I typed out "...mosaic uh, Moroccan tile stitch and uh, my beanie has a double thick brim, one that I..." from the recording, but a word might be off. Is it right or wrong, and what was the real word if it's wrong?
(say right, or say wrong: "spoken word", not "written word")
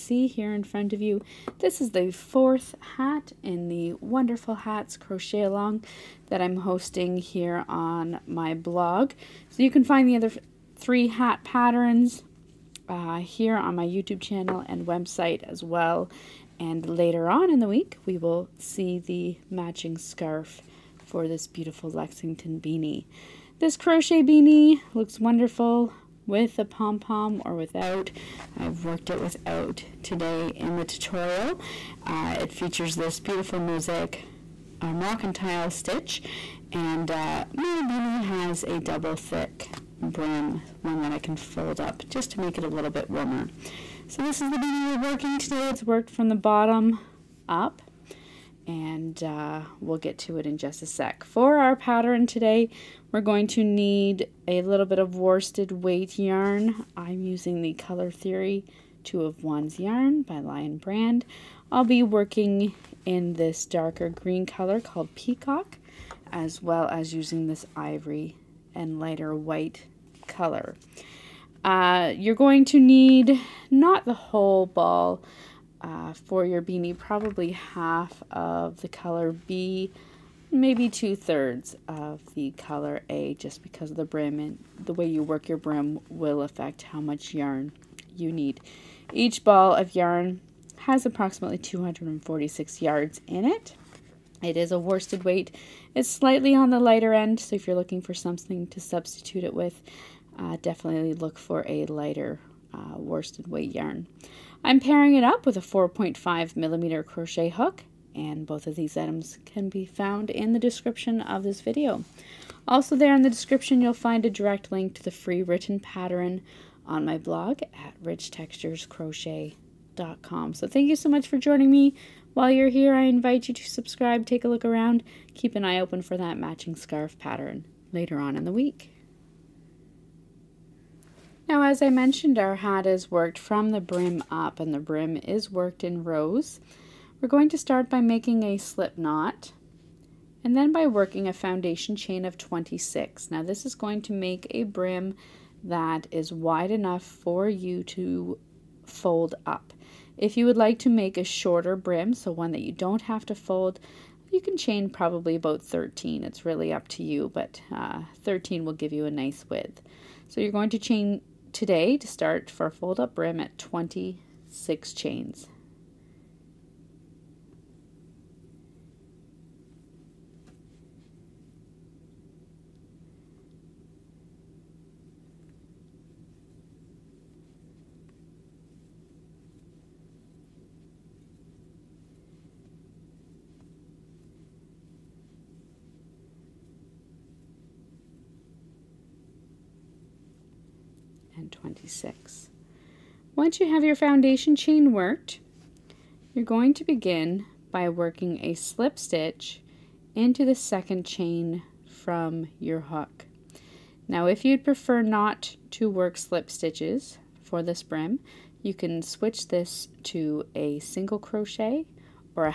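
right.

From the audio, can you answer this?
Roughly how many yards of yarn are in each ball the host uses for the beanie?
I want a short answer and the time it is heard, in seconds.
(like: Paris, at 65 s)
246, at 91 s.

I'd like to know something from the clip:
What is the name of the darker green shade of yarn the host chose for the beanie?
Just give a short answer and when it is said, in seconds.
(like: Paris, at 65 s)
Peacock, at 65 s.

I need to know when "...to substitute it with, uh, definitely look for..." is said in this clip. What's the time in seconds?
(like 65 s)
98 s.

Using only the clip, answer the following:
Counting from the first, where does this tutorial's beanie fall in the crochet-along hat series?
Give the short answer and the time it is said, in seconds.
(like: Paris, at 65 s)
fourth, at 2 s.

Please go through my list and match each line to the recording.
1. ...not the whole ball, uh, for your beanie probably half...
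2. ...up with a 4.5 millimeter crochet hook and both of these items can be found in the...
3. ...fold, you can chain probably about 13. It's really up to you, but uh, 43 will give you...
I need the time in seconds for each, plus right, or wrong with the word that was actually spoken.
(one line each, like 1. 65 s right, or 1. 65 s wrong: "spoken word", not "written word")
1. 73 s right
2. 105 s right
3. 153 s wrong: "13", not "43".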